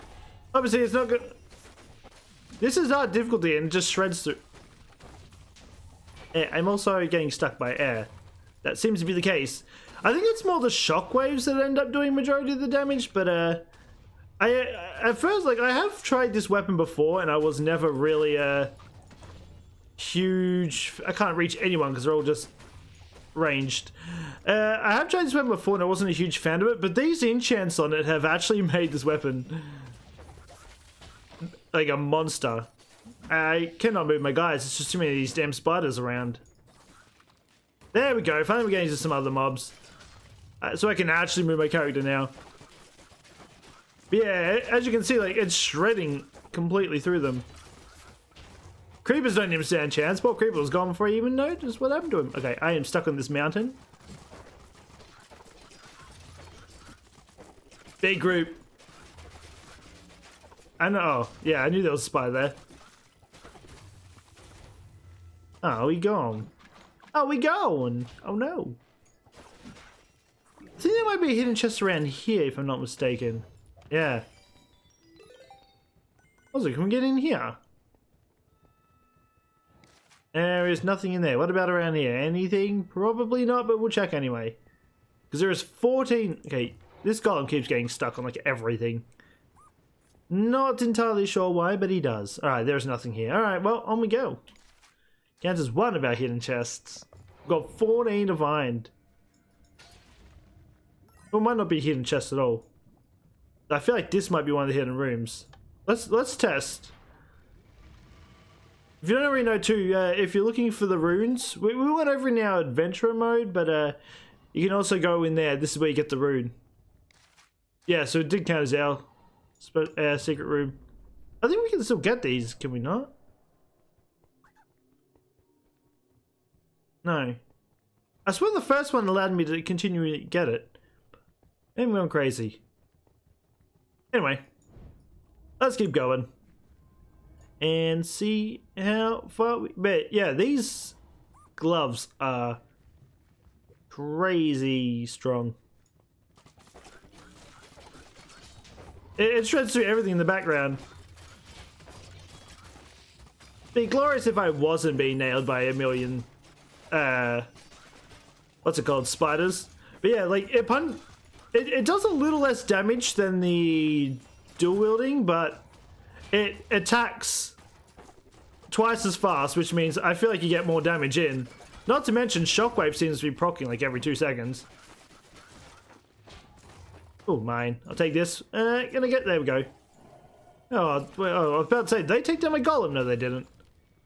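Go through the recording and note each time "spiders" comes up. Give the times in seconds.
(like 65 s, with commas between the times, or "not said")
35 s, 159 s.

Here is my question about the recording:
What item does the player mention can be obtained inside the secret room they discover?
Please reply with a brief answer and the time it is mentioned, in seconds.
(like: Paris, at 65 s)
the rune, at 116 s.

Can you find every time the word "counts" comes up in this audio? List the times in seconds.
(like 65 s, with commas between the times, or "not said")
95 s, 118 s.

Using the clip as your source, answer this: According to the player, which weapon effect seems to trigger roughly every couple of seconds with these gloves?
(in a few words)
Shockwave.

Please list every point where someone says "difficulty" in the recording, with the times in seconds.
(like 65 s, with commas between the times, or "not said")
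3 s.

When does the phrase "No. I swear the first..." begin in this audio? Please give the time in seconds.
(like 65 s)
127 s.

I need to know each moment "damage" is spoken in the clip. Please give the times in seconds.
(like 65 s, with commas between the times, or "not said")
12 s, 162 s, 170 s.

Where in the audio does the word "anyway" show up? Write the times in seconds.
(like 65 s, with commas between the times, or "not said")
84 s, 134 s.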